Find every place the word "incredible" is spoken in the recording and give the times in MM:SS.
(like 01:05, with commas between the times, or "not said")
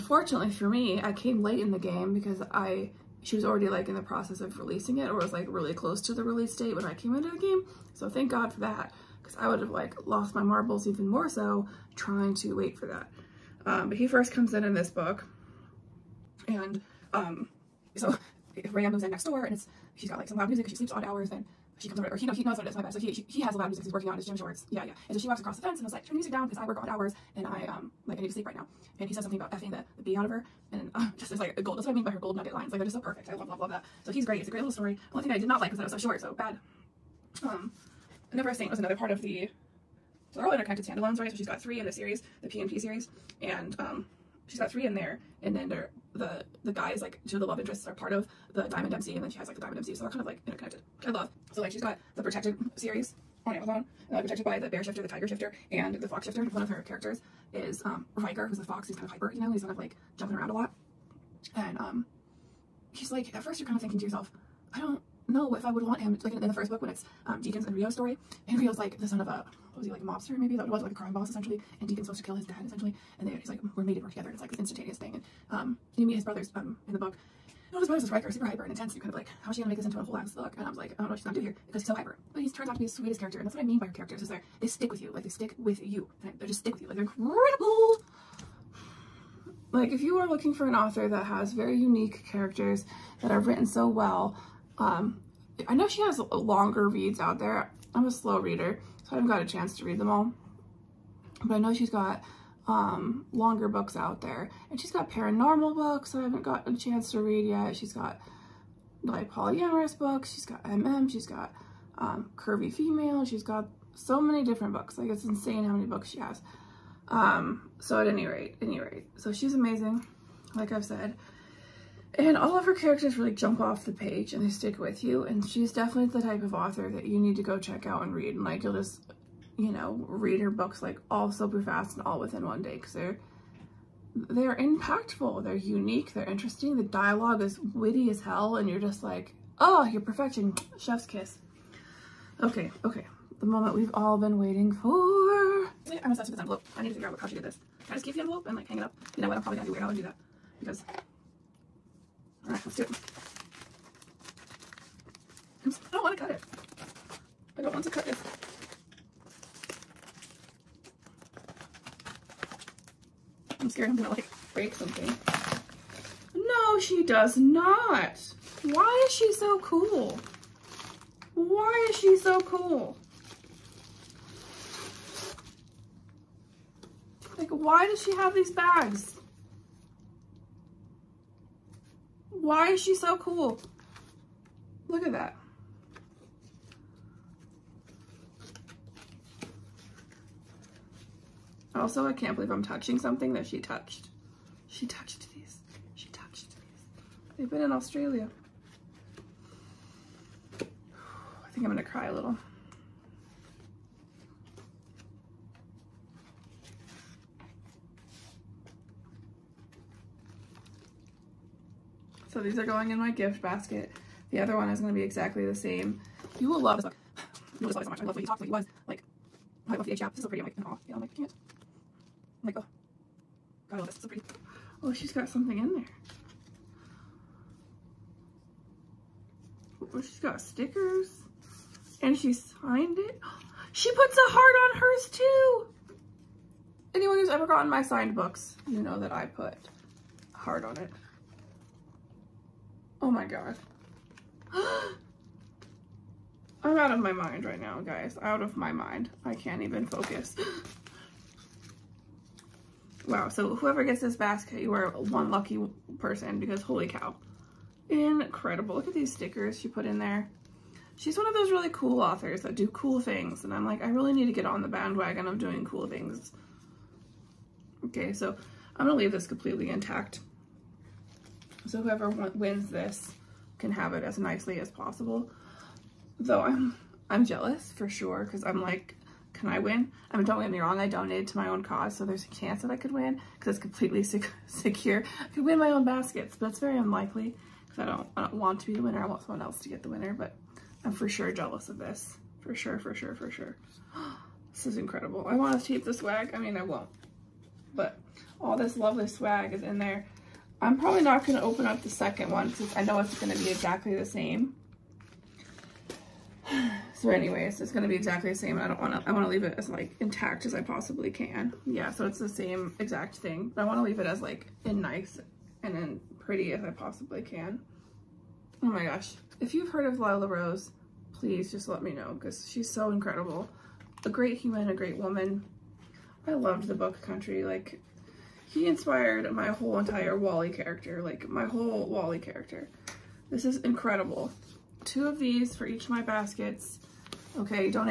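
01:27, 04:17, 04:54, 05:22, 05:33.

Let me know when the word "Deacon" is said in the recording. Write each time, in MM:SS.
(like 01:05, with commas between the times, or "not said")
01:07, 01:11.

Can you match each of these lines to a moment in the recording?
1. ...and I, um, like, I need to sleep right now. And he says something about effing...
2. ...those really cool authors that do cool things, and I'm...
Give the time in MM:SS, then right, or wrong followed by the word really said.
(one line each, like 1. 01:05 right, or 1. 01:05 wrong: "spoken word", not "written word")
1. 00:27 right
2. 04:21 right.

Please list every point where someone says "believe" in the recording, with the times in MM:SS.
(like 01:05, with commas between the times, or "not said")
03:12.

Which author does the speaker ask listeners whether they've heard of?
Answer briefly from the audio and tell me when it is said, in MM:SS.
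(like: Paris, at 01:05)
Lila Rose, at 05:19.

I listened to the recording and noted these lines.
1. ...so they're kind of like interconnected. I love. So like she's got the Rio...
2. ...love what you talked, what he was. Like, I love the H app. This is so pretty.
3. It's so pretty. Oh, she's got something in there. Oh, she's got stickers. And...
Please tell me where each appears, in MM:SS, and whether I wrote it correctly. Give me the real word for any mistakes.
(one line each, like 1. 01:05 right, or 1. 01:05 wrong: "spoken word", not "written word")
1. 00:49 wrong: "Protected", not "Rio"
2. 03:38 right
3. 03:43 right.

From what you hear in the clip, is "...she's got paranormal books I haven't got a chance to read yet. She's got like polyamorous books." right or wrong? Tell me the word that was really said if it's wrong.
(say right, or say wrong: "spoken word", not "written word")
right.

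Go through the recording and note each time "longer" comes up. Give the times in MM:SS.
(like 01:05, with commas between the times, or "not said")
01:36, 01:43.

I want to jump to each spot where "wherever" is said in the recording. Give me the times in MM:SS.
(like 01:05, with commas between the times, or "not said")
not said.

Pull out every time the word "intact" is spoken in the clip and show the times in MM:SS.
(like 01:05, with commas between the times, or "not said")
04:29, 05:09.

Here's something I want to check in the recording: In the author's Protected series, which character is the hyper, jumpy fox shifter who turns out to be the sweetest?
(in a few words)
Riker.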